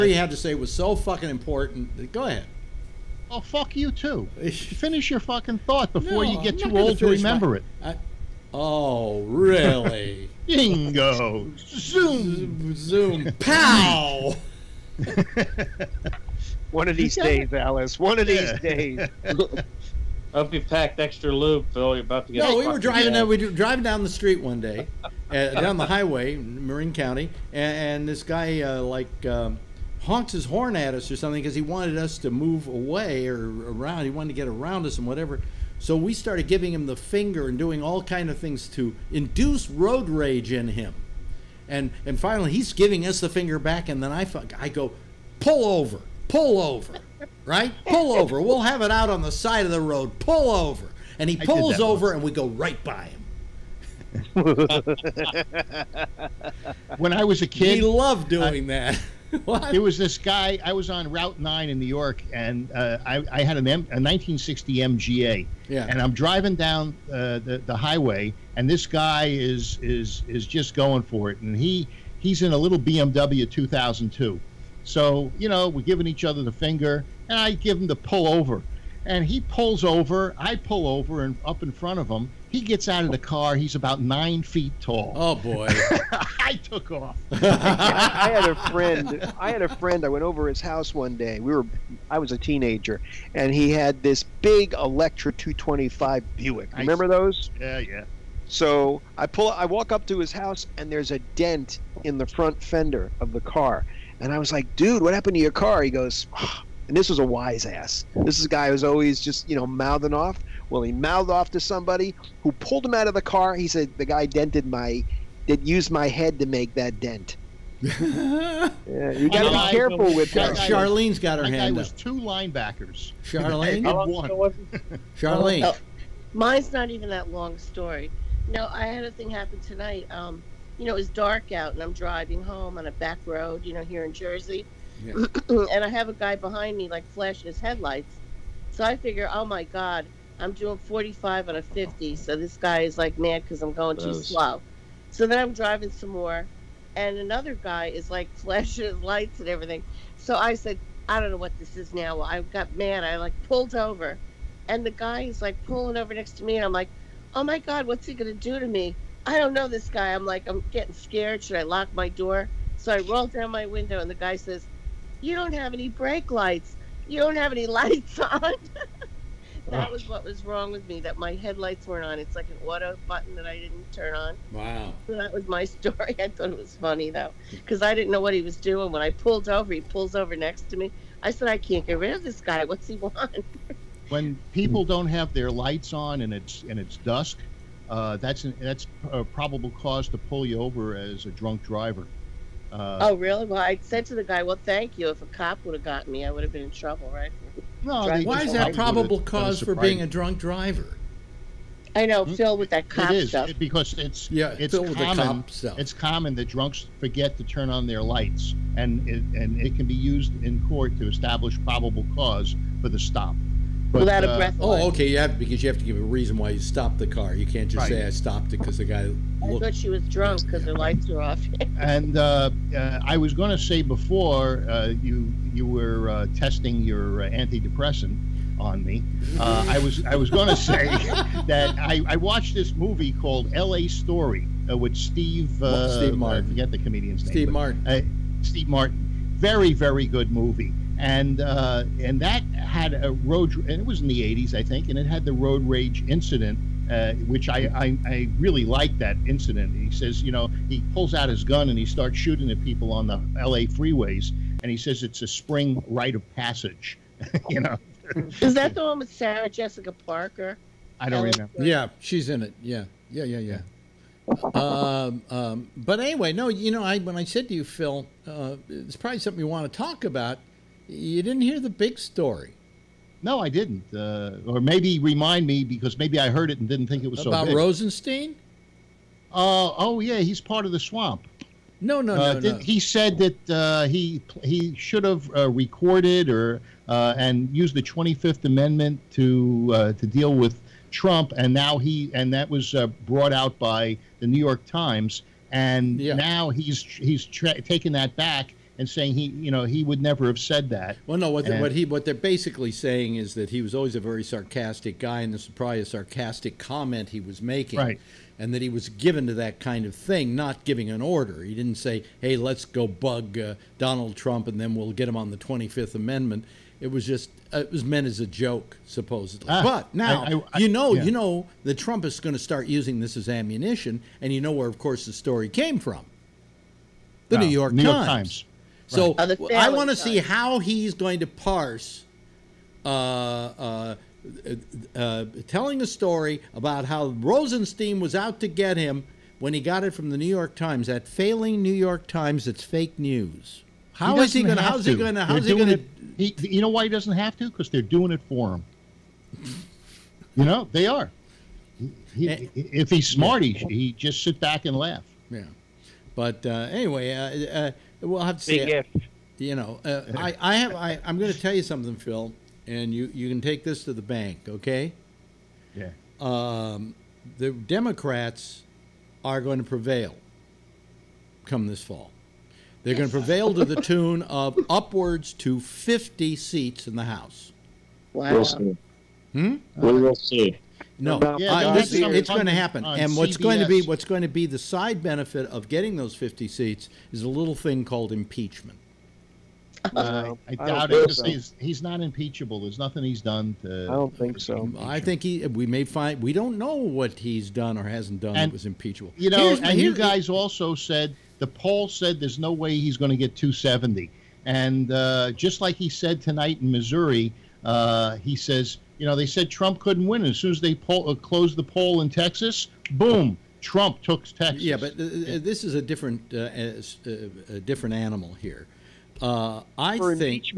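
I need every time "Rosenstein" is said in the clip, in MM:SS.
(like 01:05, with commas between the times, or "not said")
04:37, 05:37.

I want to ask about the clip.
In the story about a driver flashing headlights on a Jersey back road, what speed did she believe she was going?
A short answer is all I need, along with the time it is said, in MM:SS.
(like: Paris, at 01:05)
45, at 02:20.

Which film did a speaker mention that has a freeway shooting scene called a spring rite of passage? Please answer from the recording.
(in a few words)
L.A. Story.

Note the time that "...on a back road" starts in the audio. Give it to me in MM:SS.
02:12.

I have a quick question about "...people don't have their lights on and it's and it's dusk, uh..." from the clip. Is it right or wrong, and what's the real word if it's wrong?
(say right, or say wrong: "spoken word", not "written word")
right.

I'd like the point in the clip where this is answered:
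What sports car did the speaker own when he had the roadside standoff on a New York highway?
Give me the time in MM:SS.
01:03.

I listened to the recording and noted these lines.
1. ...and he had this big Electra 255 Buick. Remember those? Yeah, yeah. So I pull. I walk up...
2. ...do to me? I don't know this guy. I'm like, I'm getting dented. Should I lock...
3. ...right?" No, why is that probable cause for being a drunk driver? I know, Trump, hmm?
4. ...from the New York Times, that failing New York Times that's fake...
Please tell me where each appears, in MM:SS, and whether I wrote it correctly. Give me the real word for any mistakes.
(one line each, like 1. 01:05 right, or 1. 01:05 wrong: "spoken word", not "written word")
1. 01:33 wrong: "225", not "255"
2. 02:38 wrong: "scared", not "dented"
3. 03:17 wrong: "Phil", not "Trump"
4. 05:39 right.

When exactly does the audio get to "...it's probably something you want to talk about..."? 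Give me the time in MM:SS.
04:28.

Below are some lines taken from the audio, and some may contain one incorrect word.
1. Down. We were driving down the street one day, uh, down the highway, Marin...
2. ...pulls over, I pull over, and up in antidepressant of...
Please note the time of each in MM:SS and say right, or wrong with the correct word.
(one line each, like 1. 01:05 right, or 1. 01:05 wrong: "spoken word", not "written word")
1. 00:23 right
2. 01:19 wrong: "front", not "antidepressant".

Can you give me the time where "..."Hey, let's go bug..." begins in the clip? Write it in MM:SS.
05:12.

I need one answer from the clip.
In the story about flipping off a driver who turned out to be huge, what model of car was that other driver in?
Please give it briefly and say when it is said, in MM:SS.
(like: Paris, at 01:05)
BMW 2002, at 01:12.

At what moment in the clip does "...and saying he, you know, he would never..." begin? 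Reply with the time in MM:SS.
04:58.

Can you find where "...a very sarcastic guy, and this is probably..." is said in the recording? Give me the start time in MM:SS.
05:03.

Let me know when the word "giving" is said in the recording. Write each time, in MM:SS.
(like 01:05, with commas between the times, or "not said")
00:36, 00:42, 01:15, 05:10.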